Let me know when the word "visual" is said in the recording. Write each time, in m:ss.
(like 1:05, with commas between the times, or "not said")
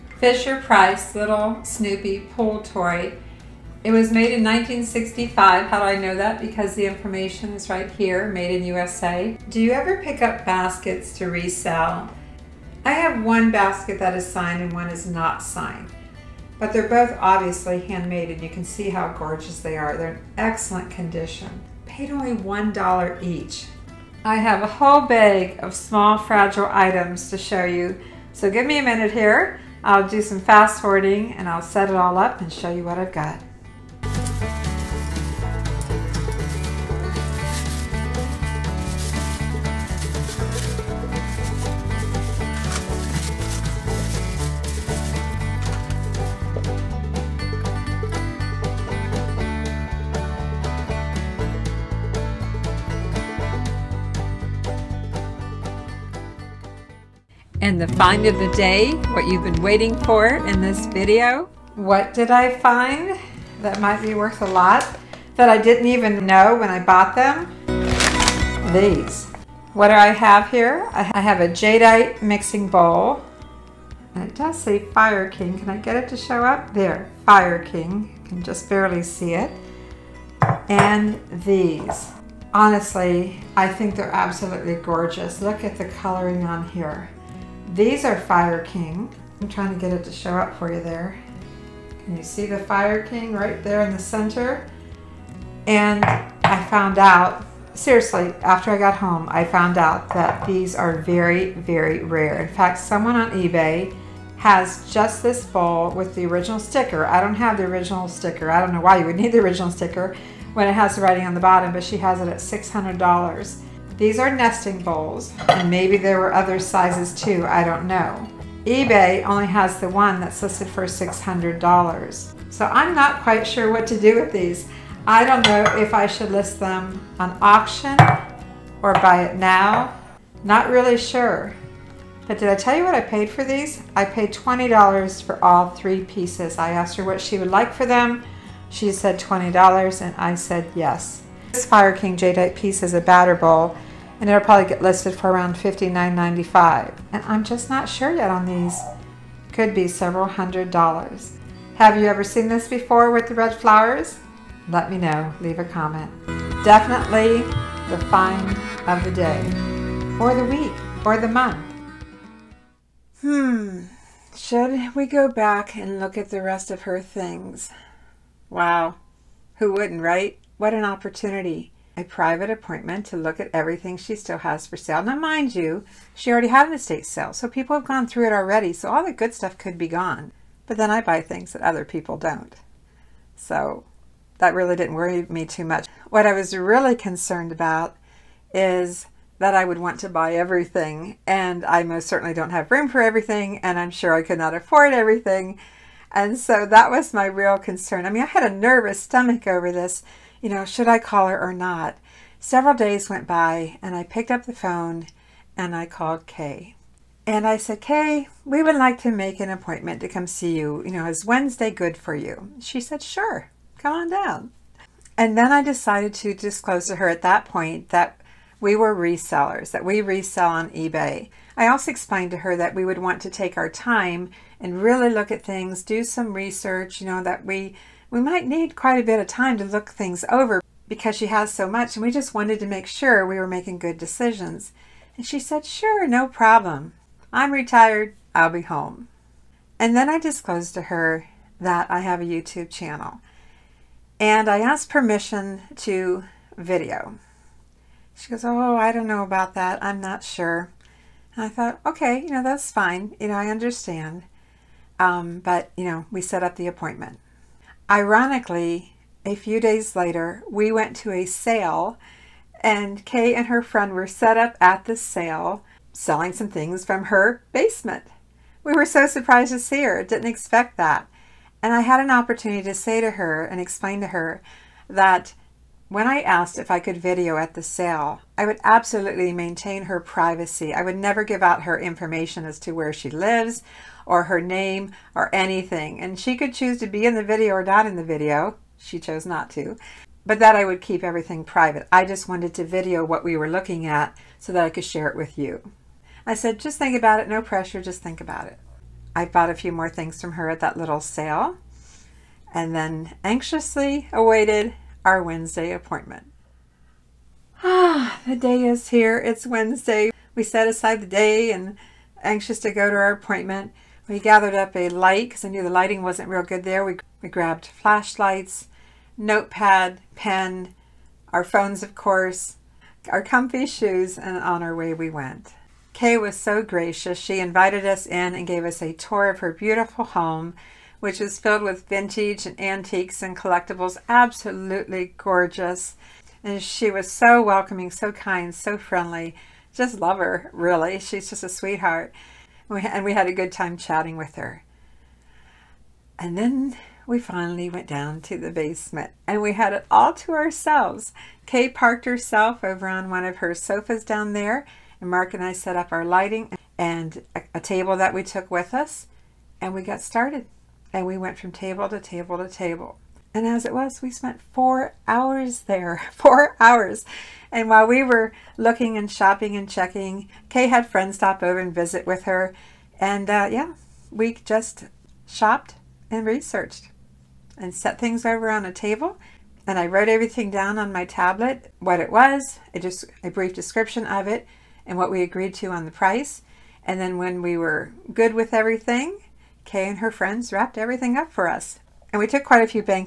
not said.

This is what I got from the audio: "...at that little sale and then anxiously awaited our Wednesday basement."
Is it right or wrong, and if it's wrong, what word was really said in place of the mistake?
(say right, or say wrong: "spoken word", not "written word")
wrong: "appointment", not "basement".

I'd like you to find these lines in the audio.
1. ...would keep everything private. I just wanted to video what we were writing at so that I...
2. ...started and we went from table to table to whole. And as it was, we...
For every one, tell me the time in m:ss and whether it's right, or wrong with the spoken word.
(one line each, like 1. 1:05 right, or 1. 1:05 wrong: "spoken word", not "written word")
1. 4:50 wrong: "looking", not "writing"
2. 6:00 wrong: "table", not "whole".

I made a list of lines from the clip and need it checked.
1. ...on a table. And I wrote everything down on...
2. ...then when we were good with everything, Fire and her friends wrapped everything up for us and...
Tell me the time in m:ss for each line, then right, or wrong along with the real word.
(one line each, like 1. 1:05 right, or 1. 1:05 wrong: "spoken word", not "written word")
1. 6:18 right
2. 6:27 wrong: "Kay", not "Fire".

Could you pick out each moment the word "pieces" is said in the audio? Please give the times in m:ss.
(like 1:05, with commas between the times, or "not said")
2:16, 2:22.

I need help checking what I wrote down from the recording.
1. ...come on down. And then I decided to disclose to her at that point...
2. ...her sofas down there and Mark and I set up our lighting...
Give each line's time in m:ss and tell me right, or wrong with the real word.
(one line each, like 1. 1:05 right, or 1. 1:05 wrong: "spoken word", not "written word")
1. 3:33 right
2. 5:53 right.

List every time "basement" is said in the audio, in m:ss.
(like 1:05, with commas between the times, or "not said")
4:27, 5:48.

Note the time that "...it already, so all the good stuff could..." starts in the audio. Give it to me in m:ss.
2:58.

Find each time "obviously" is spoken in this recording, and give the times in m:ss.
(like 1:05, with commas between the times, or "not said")
0:17.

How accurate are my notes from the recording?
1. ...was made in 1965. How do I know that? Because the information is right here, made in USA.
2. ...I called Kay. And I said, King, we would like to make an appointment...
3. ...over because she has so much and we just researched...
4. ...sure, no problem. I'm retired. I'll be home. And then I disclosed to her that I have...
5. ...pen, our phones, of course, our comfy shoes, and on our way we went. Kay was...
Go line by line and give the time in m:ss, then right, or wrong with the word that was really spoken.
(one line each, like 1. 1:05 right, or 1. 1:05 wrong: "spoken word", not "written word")
1. 0:03 right
2. 3:25 wrong: "Kay", not "King"
3. 3:50 wrong: "wanted", not "researched"
4. 3:55 right
5. 5:20 right.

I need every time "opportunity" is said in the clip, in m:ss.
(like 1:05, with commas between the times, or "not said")
2:50, 4:32.